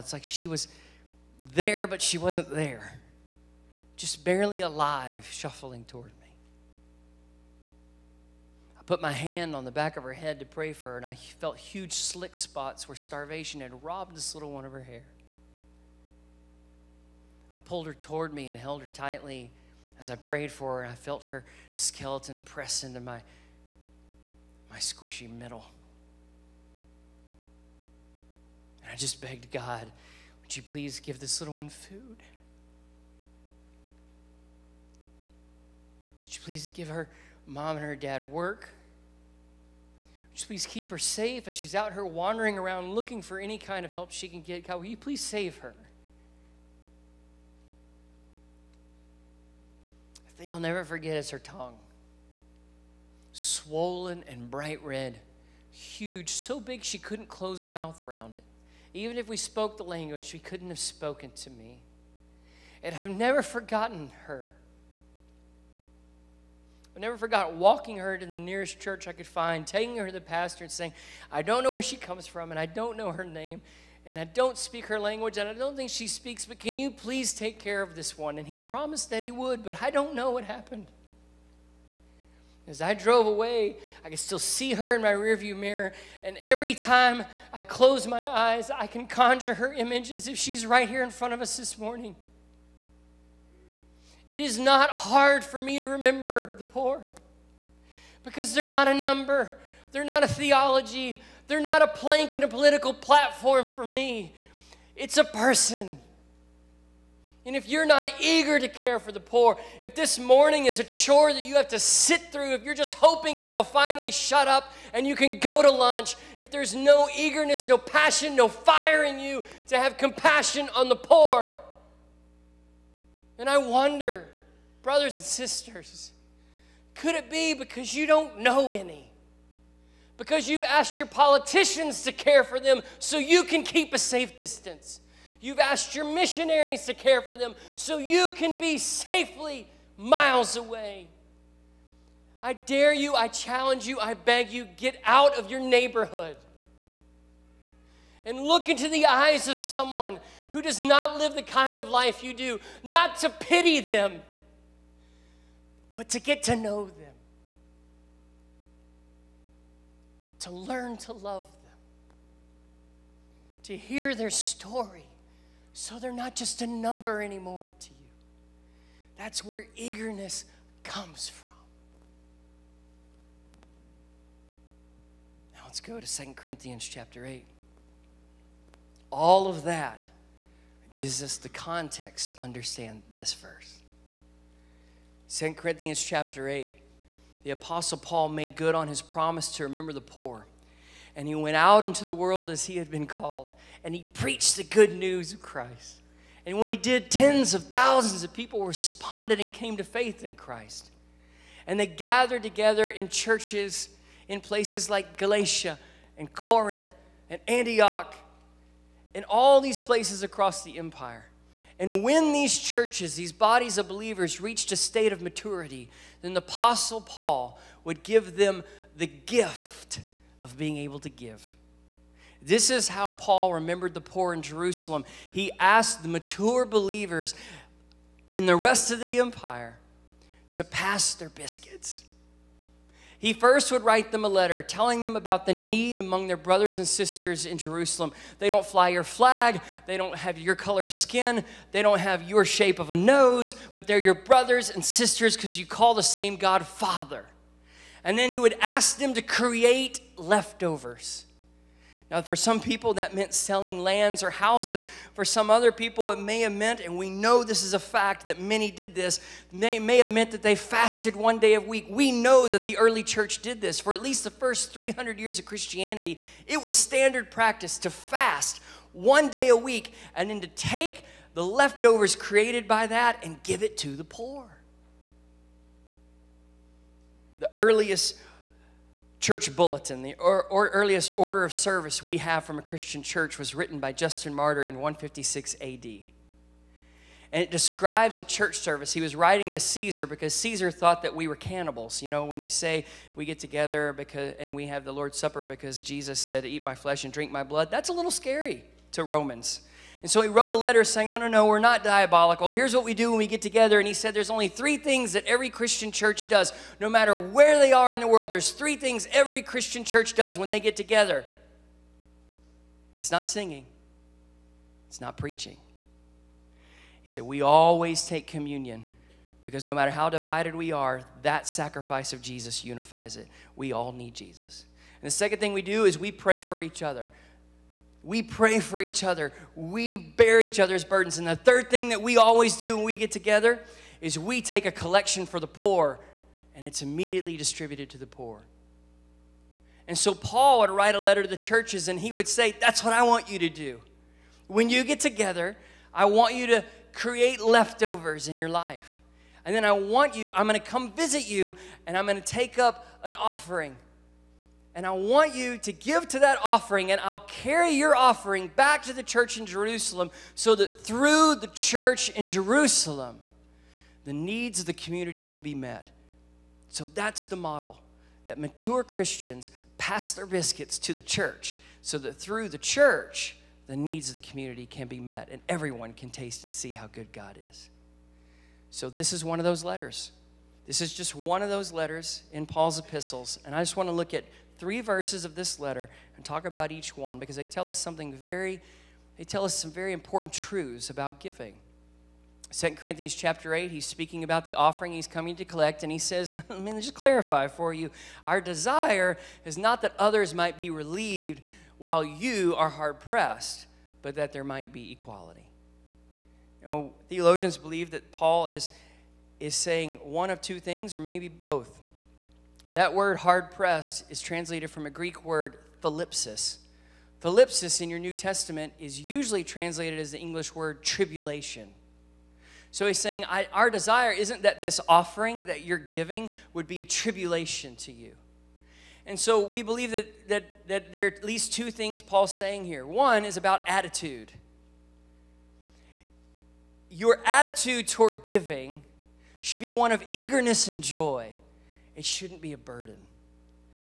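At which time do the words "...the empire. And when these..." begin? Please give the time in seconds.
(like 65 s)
210 s.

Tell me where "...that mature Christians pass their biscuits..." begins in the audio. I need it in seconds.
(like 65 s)
368 s.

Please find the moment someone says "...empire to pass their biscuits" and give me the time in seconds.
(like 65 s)
229 s.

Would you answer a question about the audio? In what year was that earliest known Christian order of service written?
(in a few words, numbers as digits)
156 AD.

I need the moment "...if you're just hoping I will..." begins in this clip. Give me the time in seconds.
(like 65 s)
112 s.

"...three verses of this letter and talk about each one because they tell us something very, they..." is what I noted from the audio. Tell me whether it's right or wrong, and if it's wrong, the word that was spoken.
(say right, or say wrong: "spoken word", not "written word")
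right.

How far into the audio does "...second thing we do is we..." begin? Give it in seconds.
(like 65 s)
325 s.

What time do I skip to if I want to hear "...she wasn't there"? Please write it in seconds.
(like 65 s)
2 s.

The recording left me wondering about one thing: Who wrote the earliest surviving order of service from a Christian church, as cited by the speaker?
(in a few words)
Justin Martyr.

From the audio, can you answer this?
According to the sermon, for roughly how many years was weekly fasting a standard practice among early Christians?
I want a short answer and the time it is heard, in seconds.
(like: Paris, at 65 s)
300, at 264 s.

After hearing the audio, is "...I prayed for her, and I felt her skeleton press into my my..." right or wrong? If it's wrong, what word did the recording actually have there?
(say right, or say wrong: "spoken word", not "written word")
right.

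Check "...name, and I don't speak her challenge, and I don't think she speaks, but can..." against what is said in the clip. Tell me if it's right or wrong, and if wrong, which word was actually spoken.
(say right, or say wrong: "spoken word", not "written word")
wrong: "language", not "challenge".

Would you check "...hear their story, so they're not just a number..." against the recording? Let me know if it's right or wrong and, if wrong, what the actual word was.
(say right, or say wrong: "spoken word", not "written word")
right.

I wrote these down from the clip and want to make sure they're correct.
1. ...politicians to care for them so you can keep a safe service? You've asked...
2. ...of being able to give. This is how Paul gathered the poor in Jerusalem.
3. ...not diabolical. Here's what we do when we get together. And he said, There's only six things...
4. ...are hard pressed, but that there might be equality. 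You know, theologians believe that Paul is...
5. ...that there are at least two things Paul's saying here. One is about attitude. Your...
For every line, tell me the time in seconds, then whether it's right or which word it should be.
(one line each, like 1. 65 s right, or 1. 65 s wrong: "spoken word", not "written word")
1. 131 s wrong: "distance", not "service"
2. 220 s wrong: "remembered", not "gathered"
3. 301 s wrong: "three", not "six"
4. 402 s right
5. 430 s right.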